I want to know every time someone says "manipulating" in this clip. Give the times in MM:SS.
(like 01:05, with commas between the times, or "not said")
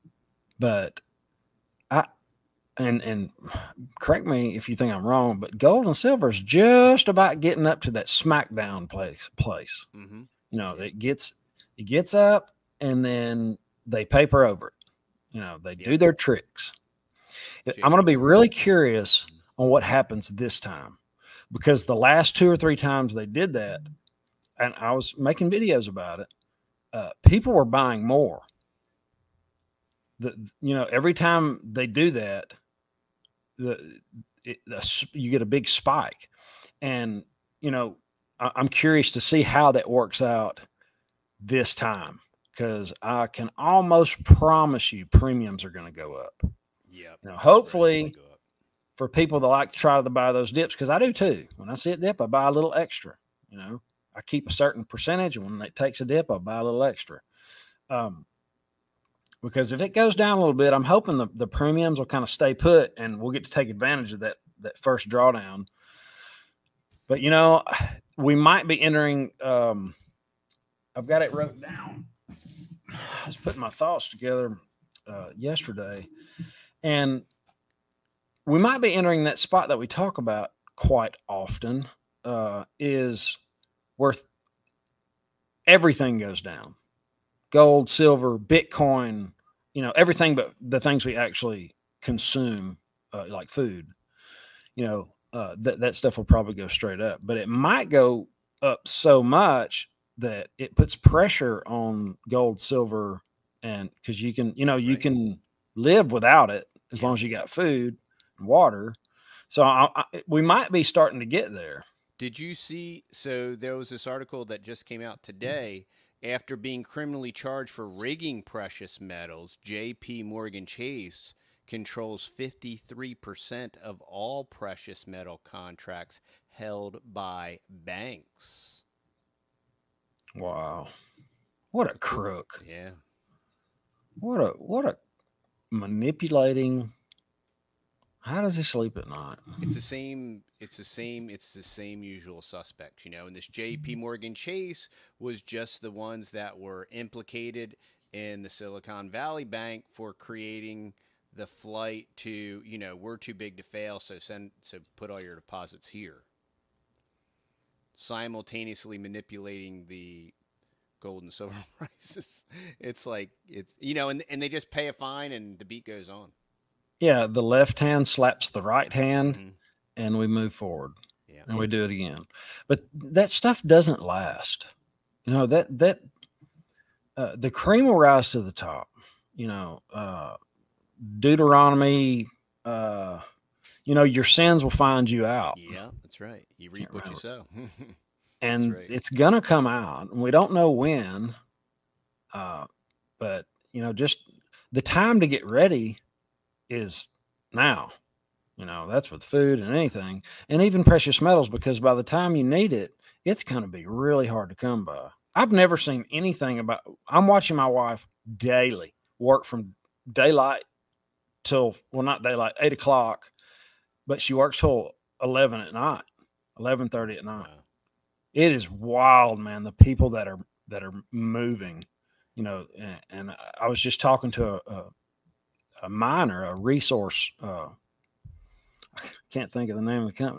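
02:15, 02:38.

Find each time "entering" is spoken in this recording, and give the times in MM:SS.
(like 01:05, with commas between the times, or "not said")
01:08, 01:18.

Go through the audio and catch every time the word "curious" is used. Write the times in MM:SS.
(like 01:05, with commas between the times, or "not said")
00:18, 00:38.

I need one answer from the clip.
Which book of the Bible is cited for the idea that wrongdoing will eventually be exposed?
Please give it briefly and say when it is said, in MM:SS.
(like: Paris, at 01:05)
Deuteronomy, at 03:01.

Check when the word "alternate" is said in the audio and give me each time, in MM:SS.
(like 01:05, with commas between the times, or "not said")
not said.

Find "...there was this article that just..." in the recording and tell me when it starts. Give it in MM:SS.
01:53.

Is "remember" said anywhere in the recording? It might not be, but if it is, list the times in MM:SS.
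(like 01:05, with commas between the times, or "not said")
03:07.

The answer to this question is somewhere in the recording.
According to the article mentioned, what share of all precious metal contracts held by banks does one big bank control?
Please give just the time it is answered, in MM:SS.
02:02.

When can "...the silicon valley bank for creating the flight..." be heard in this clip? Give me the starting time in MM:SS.
02:28.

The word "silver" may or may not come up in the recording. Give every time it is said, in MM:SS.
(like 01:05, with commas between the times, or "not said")
00:05, 01:27, 01:42, 02:41.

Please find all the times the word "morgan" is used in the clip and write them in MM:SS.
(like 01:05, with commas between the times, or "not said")
02:00, 02:24.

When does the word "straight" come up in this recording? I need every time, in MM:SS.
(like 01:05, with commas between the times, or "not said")
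01:36.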